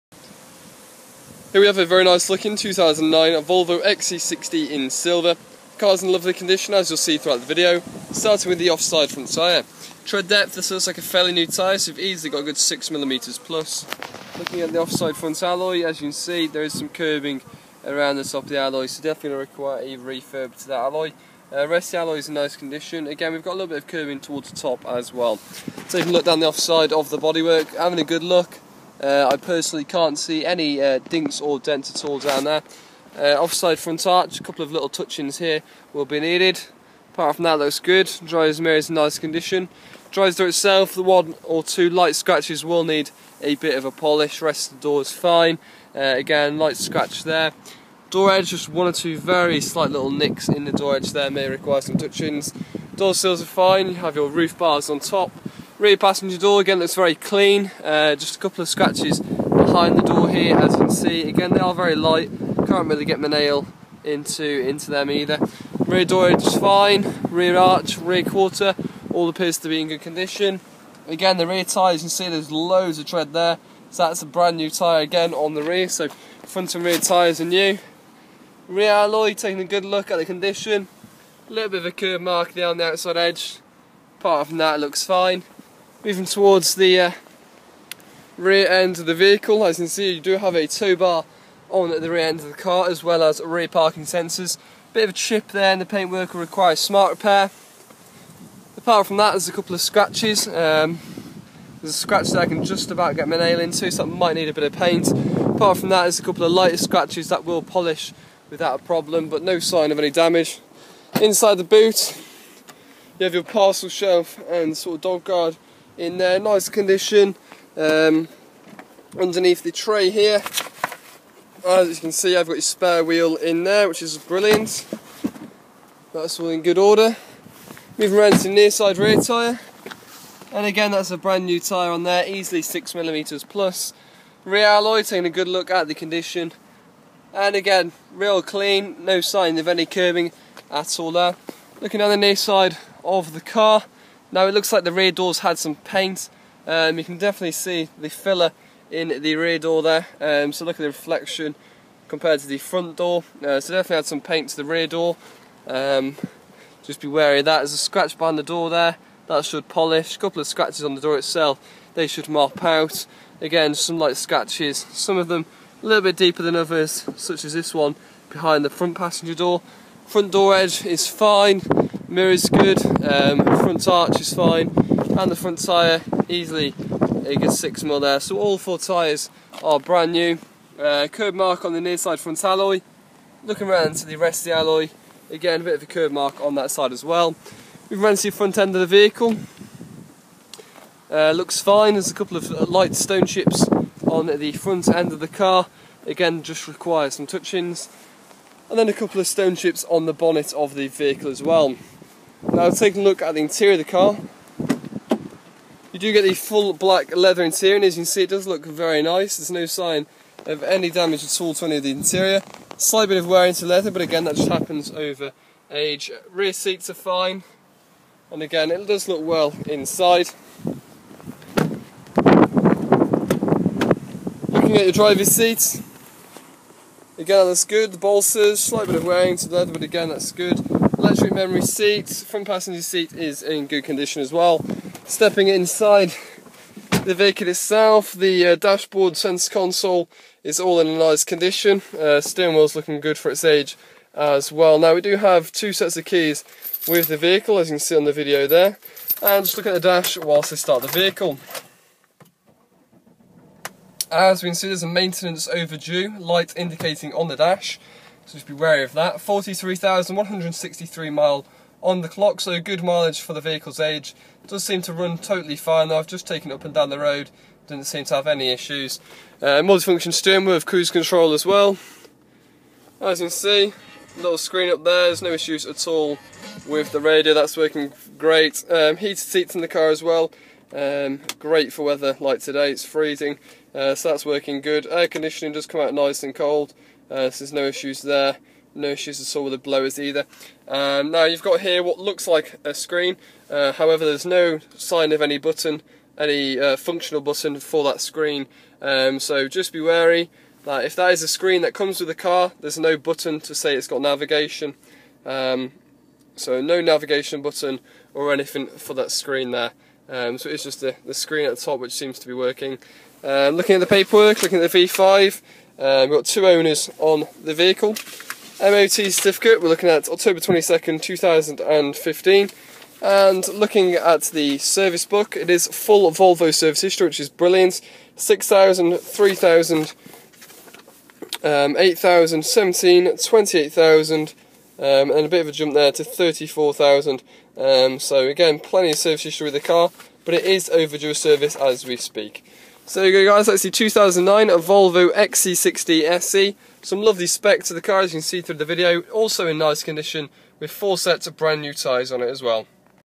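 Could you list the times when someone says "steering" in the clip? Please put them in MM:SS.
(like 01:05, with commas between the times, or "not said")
04:02, 04:30.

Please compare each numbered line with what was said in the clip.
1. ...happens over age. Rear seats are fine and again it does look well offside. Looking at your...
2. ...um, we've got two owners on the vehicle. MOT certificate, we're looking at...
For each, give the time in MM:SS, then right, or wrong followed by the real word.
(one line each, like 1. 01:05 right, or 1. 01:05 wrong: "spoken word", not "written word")
1. 03:34 wrong: "inside", not "offside"
2. 05:15 right.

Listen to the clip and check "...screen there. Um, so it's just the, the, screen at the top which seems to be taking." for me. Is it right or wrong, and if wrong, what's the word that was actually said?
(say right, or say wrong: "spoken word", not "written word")
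wrong: "working", not "taking".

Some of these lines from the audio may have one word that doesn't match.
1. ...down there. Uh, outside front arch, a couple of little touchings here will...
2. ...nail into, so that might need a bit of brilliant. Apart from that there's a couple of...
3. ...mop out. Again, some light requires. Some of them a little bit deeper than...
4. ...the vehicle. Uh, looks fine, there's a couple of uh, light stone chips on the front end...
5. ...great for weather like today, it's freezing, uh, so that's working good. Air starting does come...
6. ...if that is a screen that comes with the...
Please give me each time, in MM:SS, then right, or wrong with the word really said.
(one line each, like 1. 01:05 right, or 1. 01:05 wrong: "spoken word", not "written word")
1. 00:32 wrong: "offside", not "outside"
2. 01:43 wrong: "paint", not "brilliant"
3. 02:42 wrong: "scratches", not "requires"
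4. 03:08 right
5. 04:41 wrong: "conditioning", not "starting"
6. 05:00 right.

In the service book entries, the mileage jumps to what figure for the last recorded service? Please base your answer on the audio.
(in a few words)
34,000.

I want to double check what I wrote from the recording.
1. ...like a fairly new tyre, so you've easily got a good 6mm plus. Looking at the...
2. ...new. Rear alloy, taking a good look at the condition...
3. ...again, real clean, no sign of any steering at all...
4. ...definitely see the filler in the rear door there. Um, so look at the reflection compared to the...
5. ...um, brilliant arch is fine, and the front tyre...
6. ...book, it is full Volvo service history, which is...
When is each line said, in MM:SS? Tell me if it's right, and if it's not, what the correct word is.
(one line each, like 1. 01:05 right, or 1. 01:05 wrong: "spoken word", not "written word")
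1. 00:10 right
2. 01:17 right
3. 02:17 wrong: "curbing", not "steering"
4. 02:27 right
5. 02:53 wrong: "front", not "brilliant"
6. 05:25 right.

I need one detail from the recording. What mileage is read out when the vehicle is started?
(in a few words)
43,163.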